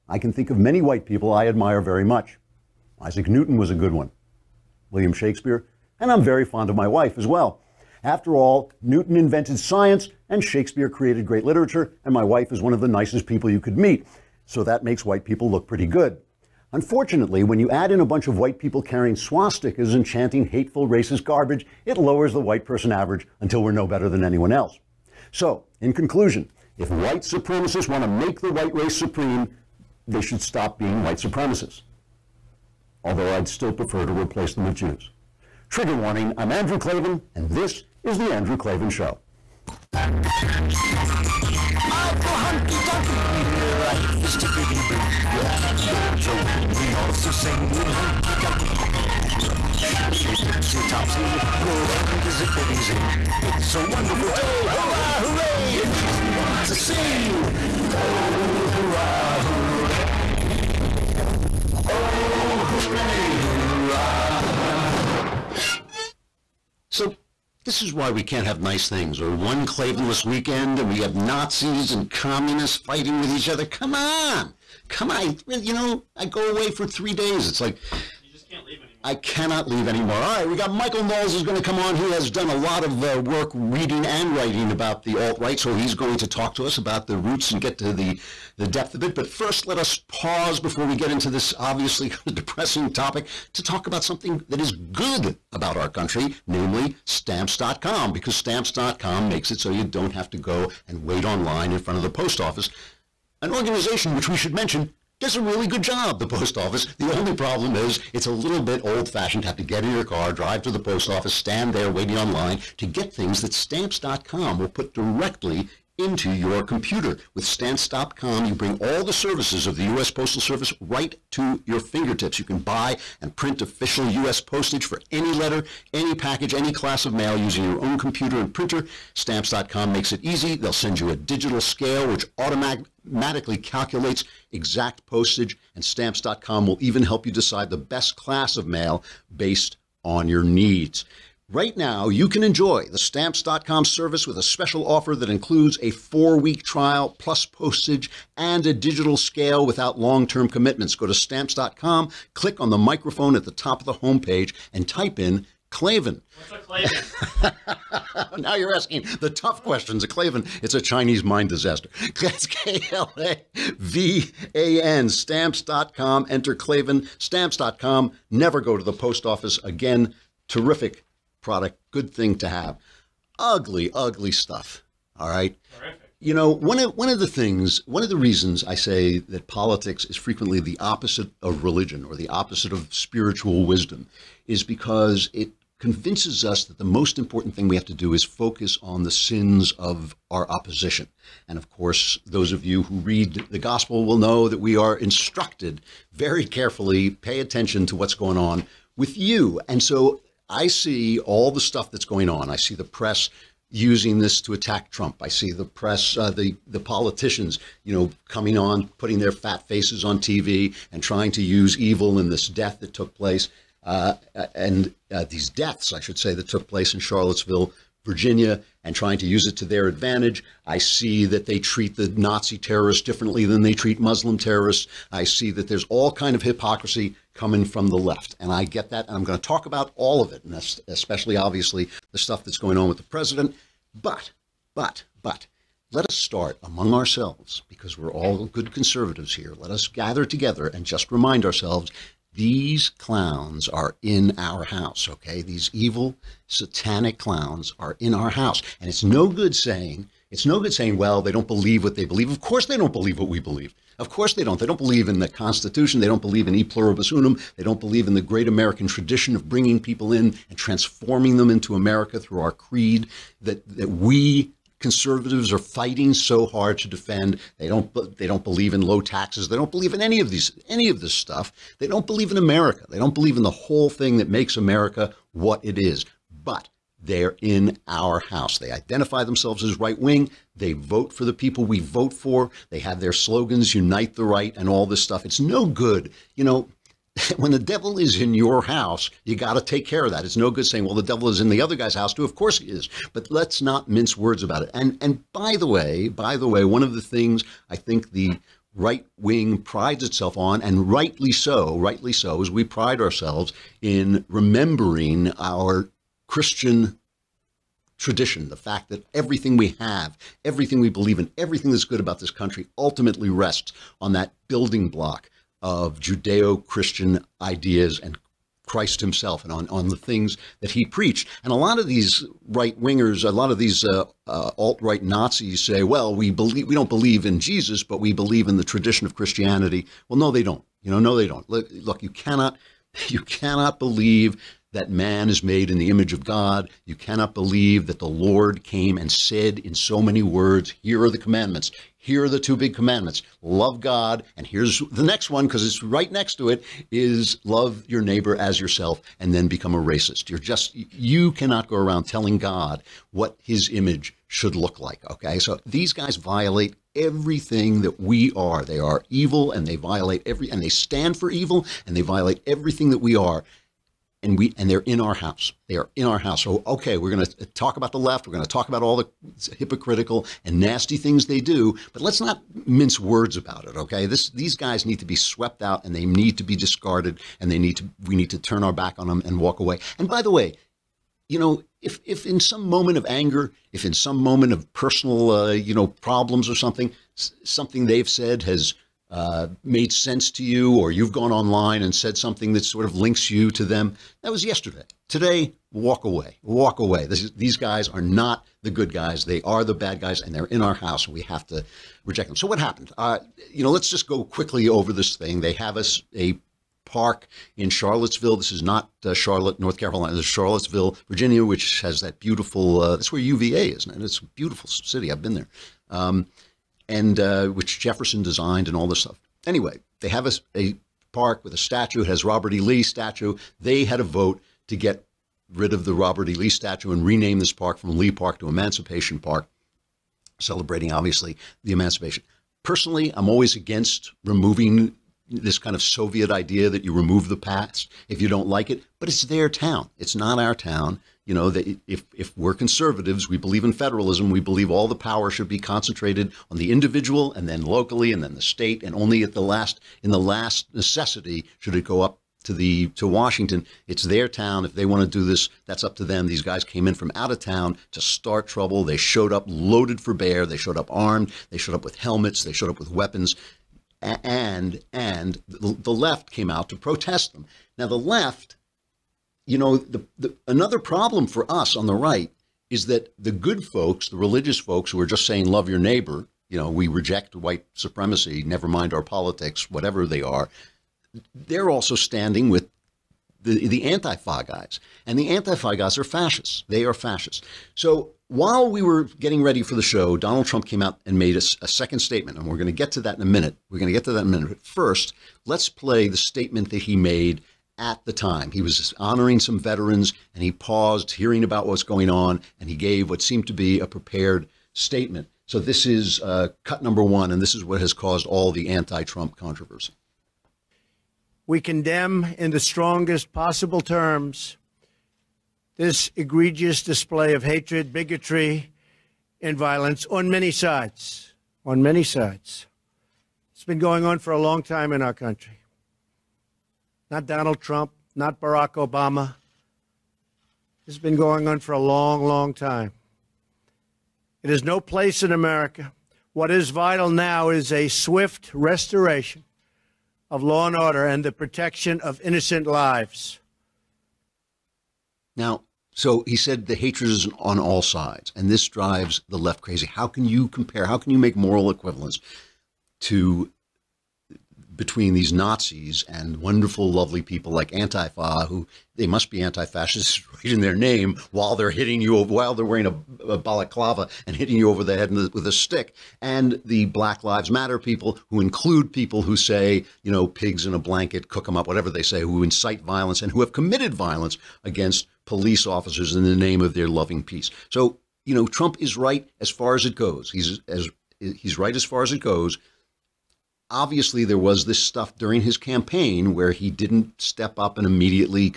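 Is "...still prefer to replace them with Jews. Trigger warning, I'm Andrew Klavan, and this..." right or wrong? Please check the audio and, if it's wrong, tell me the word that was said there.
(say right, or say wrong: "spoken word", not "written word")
right.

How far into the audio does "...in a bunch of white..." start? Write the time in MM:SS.
00:17.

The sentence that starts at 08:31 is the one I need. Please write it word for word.
We condemn in the strongest possible terms this egregious display of hatred, bigotry, and violence on many sides.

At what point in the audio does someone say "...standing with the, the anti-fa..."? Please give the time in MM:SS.
08:01.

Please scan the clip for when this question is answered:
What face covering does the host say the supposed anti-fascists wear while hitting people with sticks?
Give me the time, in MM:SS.
09:23.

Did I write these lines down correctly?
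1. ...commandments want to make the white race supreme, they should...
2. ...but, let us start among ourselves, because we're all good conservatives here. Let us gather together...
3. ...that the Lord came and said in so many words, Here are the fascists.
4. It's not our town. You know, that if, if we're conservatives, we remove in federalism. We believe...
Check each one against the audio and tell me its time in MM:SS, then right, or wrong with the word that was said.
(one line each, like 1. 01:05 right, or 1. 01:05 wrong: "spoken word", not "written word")
1. 00:27 wrong: "supremacists", not "commandments"
2. 03:55 right
3. 05:37 wrong: "commandments", not "fascists"
4. 07:19 wrong: "believe", not "remove".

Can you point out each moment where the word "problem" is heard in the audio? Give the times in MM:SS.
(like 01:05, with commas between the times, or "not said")
01:47, 06:25, 07:50.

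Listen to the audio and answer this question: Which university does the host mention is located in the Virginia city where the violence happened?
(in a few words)
UVA.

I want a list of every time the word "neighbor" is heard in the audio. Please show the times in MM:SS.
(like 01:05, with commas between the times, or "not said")
05:48, 07:55.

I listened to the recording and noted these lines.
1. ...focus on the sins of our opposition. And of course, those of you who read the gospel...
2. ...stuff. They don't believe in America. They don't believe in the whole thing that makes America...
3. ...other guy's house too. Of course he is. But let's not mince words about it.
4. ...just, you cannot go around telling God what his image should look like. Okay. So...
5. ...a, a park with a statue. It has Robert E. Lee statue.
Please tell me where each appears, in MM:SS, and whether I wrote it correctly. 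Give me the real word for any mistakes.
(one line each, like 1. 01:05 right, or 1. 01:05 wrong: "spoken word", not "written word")
1. 03:08 right
2. 04:31 right
3. 04:51 right
4. 05:50 right
5. 07:00 right.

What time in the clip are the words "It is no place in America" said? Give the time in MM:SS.
08:54.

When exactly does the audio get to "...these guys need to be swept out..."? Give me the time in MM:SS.
06:14.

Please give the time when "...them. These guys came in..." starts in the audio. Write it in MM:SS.
07:36.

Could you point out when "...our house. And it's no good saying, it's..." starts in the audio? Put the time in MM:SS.
04:08.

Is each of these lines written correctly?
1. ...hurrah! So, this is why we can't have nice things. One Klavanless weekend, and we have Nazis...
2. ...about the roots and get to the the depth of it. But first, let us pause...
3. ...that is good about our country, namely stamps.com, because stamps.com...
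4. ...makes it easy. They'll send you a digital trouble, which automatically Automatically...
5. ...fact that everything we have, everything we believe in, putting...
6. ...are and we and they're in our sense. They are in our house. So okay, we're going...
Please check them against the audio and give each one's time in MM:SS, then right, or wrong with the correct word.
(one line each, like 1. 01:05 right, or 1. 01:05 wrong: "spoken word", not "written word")
1. 01:03 right
2. 01:26 right
3. 01:34 right
4. 02:09 wrong: "scale", not "trouble"
5. 05:08 wrong: "everything", not "putting"
6. 06:03 wrong: "house", not "sense".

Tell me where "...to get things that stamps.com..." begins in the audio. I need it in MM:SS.
01:52.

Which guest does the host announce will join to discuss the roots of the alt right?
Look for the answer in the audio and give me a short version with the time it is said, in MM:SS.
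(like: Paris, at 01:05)
Michael Knowles, at 01:20.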